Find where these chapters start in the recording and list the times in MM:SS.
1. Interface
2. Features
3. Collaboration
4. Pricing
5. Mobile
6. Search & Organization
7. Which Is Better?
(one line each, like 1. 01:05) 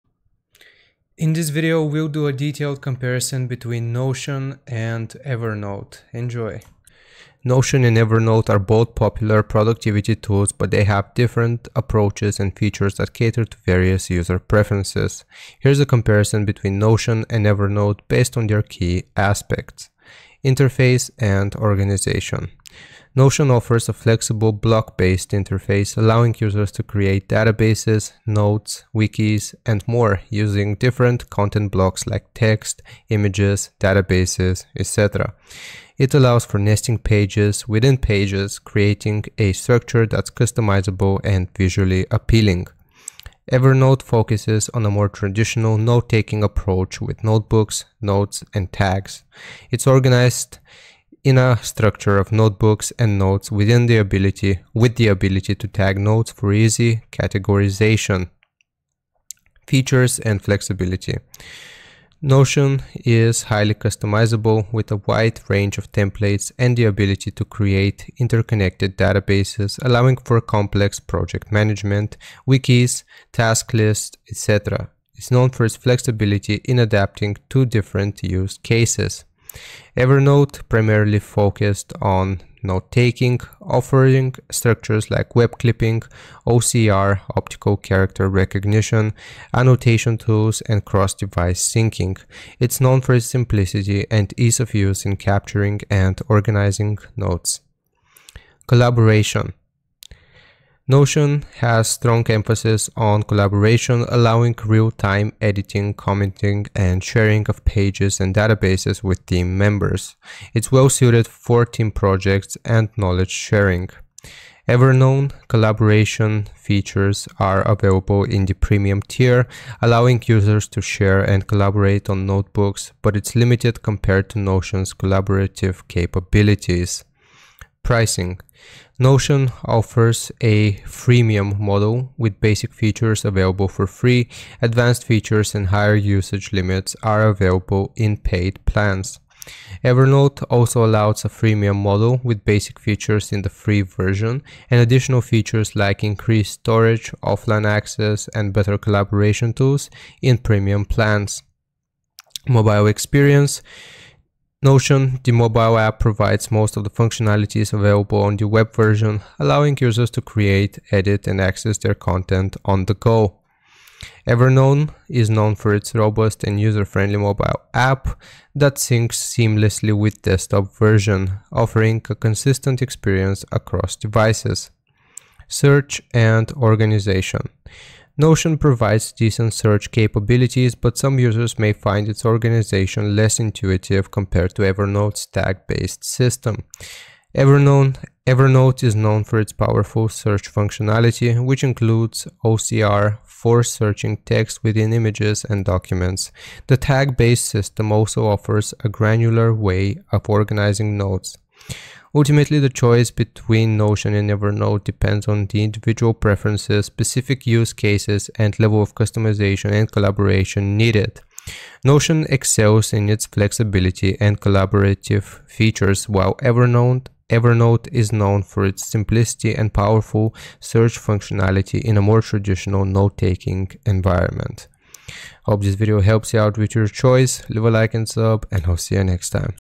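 1. 00:20
2. 01:00
3. 01:40
4. 02:08
5. 02:32
6. 02:55
7. 03:22.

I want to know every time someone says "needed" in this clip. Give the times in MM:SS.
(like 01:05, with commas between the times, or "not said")
03:30.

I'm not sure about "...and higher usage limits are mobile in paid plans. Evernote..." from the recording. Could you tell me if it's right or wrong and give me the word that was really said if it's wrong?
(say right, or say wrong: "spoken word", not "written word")
wrong: "available", not "mobile".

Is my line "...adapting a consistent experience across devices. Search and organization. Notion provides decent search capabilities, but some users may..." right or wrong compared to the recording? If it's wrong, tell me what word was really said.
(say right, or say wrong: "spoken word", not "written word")
wrong: "offering", not "adapting".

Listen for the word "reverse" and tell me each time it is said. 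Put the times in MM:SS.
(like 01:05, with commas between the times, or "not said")
not said.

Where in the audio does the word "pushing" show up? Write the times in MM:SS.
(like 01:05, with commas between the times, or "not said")
not said.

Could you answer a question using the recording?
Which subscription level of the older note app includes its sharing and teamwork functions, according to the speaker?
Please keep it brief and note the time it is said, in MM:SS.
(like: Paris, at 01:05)
premium tier, at 01:58.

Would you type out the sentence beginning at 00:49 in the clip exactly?
It's organized in a structure of notebooks and notes within the ability with the ability to tag notes for easy categorization.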